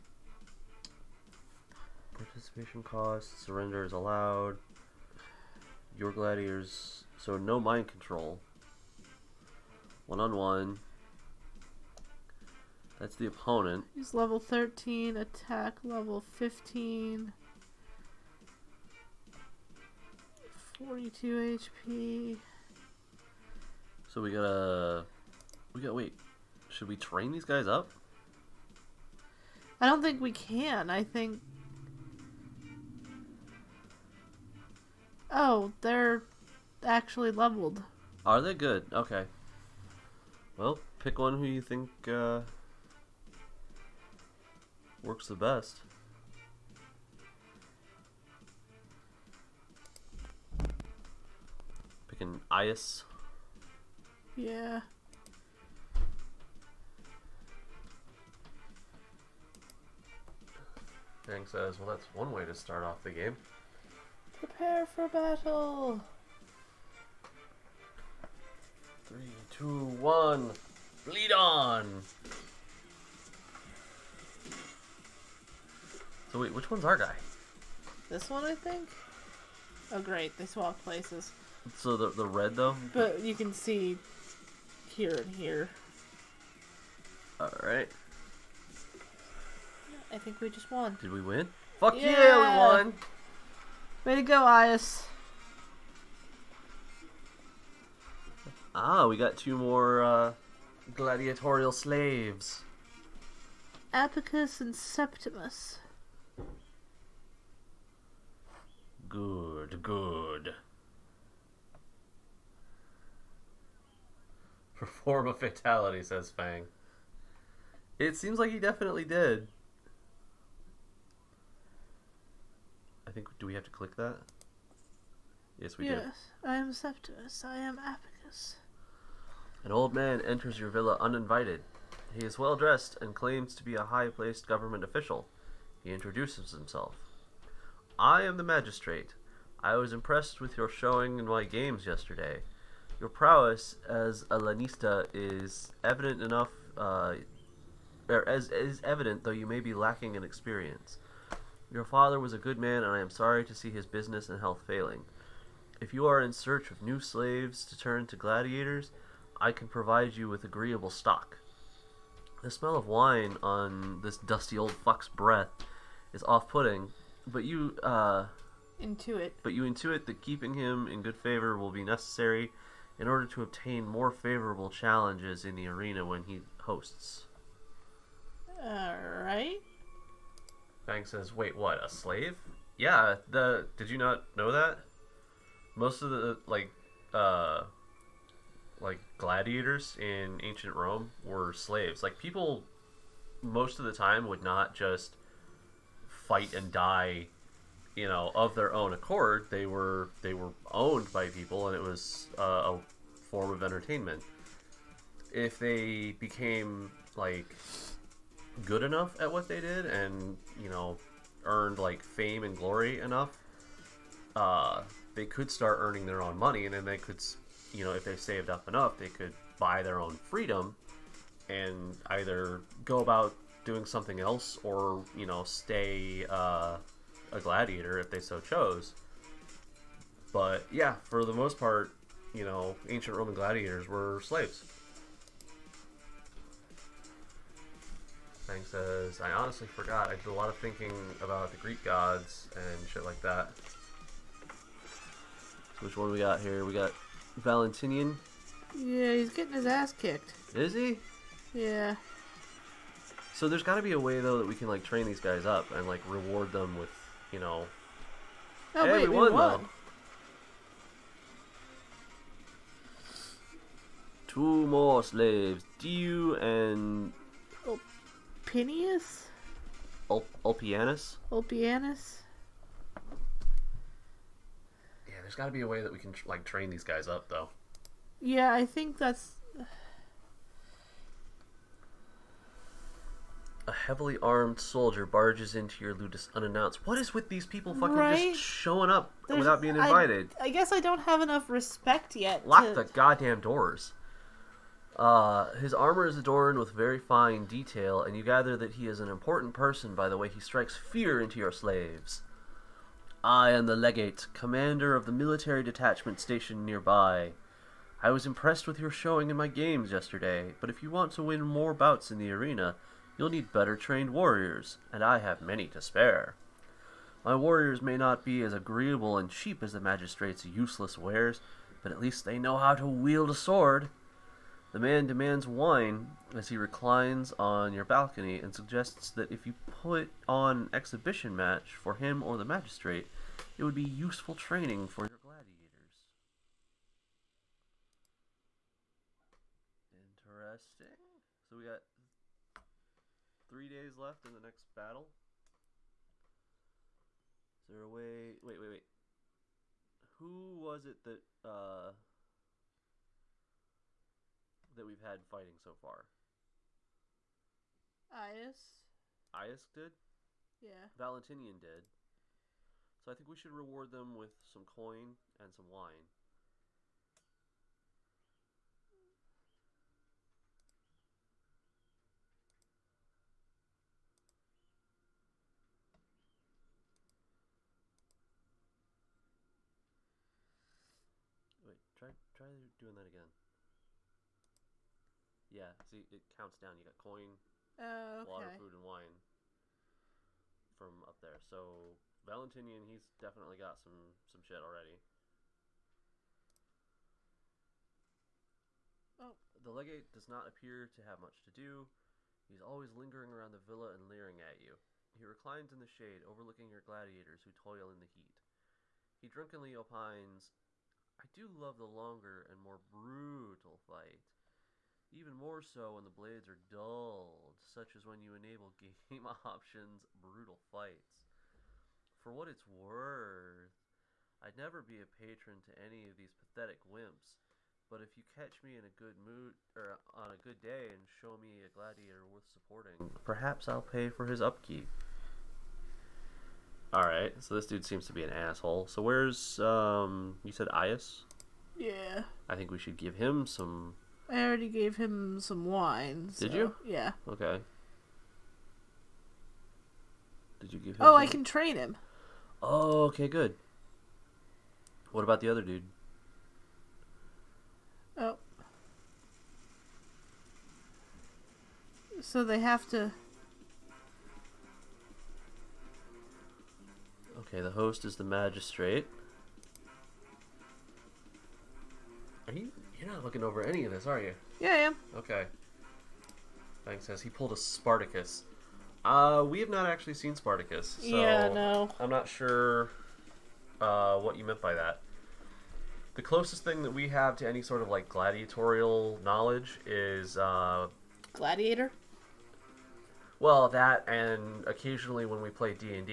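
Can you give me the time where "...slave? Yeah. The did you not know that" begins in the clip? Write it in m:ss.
3:01.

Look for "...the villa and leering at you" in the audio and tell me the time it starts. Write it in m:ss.
6:43.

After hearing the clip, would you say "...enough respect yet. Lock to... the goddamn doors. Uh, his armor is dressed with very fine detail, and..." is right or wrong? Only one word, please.
wrong.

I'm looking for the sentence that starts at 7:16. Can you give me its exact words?
All right, so this dude seems to be an asshole.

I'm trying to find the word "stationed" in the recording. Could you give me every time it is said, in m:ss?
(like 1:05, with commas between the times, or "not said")
5:06.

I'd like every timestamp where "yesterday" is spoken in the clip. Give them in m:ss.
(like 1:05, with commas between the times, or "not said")
2:21, 5:09.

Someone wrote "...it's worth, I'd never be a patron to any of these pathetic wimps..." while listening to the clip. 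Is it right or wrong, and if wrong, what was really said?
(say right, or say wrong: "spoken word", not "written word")
right.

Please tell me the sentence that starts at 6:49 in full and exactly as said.
He drunkenly opines I do love the longer and more brutal fight.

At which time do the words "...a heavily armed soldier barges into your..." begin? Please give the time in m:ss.
4:43.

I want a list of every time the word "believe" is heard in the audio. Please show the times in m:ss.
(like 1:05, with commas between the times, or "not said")
not said.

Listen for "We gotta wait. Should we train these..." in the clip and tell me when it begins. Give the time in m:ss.
0:25.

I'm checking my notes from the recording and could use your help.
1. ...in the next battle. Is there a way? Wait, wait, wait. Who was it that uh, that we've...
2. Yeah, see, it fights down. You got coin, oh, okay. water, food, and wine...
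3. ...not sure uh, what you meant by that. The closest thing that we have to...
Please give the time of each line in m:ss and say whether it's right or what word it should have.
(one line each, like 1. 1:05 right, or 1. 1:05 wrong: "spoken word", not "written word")
1. 5:44 right
2. 6:25 wrong: "counts", not "fights"
3. 8:02 right.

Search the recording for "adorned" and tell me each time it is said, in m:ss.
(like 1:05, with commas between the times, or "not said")
4:56.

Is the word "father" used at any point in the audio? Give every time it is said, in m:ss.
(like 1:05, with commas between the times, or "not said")
2:31.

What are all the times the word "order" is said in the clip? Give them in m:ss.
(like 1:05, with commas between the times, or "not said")
2:53.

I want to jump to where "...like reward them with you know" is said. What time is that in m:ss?
4:15.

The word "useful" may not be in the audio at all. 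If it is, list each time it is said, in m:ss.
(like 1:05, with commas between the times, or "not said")
5:33.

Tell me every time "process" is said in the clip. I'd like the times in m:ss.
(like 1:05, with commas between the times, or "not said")
not said.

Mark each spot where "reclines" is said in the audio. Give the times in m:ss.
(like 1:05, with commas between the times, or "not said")
5:26, 6:45.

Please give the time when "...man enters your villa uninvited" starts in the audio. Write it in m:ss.
2:09.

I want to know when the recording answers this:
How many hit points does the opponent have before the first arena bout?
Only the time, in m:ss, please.
0:20.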